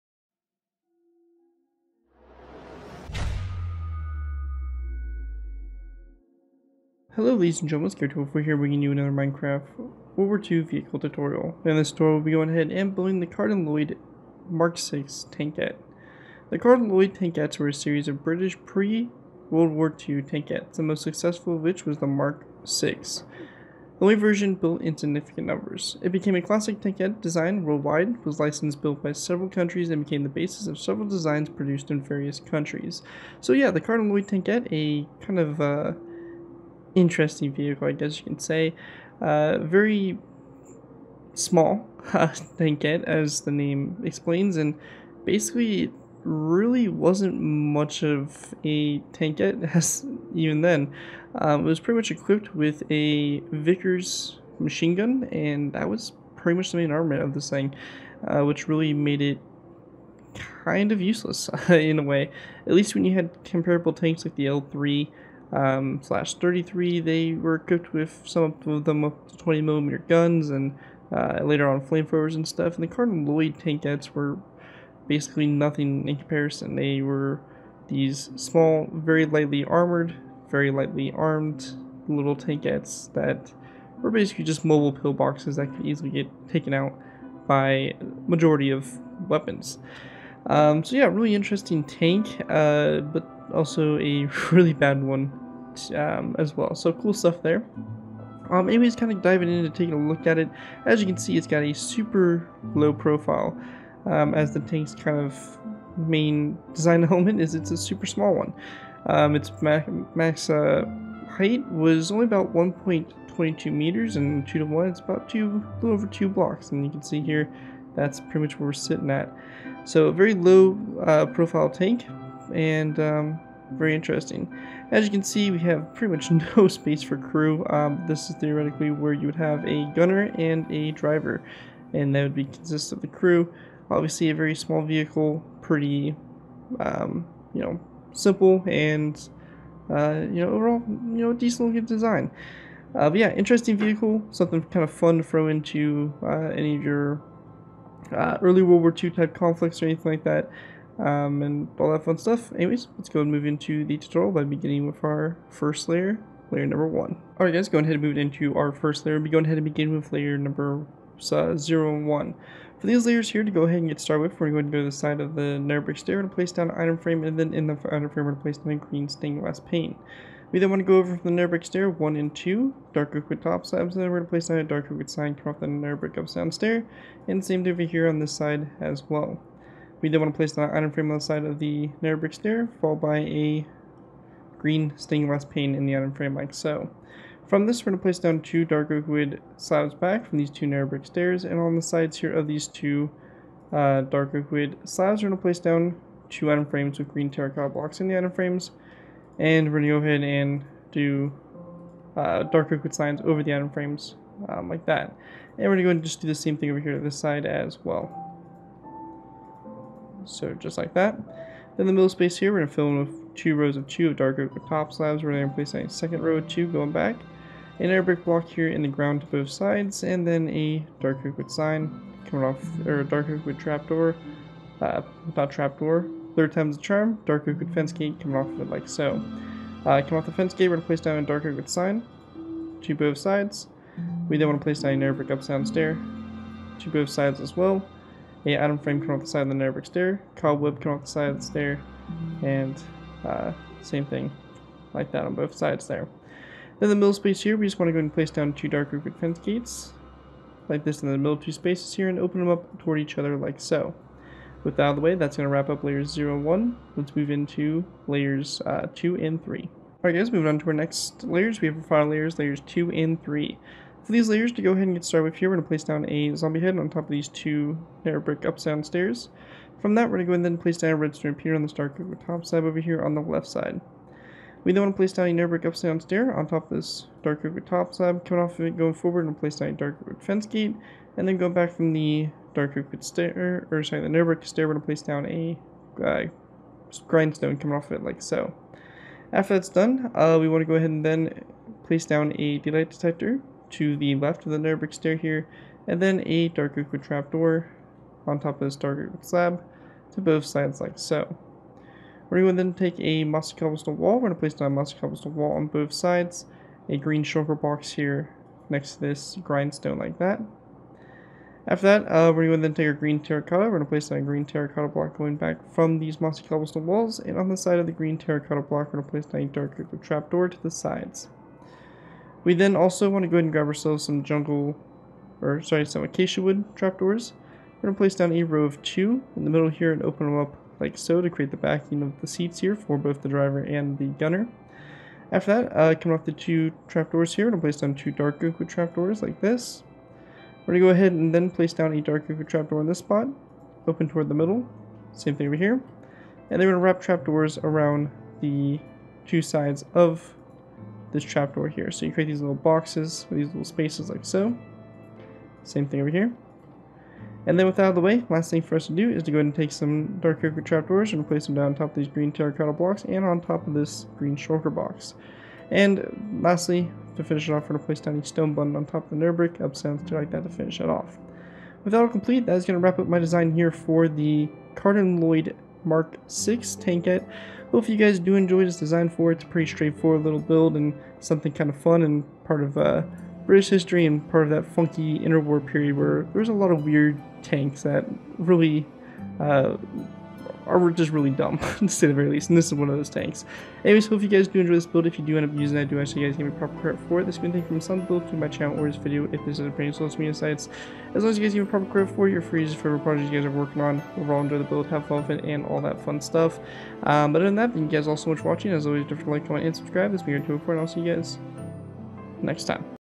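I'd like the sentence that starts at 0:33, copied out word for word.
So yeah, the Carden-Loyd tankette, a kind of uh, interesting vehicle, I guess you can say.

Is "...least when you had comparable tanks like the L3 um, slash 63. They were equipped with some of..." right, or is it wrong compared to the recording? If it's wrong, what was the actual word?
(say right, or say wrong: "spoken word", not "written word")
wrong: "33", not "63".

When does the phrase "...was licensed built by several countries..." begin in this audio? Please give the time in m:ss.
0:28.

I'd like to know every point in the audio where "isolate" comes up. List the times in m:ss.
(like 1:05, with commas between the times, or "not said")
not said.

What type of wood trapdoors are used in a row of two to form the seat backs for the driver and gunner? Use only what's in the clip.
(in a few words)
acacia.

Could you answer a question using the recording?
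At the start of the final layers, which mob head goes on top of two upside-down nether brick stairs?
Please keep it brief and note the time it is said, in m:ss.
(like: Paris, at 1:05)
zombie head, at 4:26.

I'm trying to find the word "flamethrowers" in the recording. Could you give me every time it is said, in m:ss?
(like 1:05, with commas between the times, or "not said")
1:11.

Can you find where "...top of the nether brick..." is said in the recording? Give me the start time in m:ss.
6:08.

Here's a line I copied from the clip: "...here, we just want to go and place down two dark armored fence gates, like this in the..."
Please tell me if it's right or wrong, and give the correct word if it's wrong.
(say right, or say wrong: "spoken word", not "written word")
wrong: "roofed", not "armored".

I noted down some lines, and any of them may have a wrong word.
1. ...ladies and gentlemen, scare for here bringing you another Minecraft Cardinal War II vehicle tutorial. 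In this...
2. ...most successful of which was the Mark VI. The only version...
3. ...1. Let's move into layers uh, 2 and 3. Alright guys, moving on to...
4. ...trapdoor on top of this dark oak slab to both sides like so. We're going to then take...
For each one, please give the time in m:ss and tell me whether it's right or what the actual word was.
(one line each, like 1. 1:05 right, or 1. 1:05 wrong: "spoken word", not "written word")
1. 0:07 wrong: "World", not "Cardinal"
2. 0:20 right
3. 4:16 right
4. 4:57 right.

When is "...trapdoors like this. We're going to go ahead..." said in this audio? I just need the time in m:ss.
5:38.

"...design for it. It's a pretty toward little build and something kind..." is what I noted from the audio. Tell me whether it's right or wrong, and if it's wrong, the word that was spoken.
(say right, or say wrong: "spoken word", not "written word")
wrong: "straightforward", not "toward".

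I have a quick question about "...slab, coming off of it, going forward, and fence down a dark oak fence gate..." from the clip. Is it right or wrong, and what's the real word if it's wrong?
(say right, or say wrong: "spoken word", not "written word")
wrong: "place", not "fence".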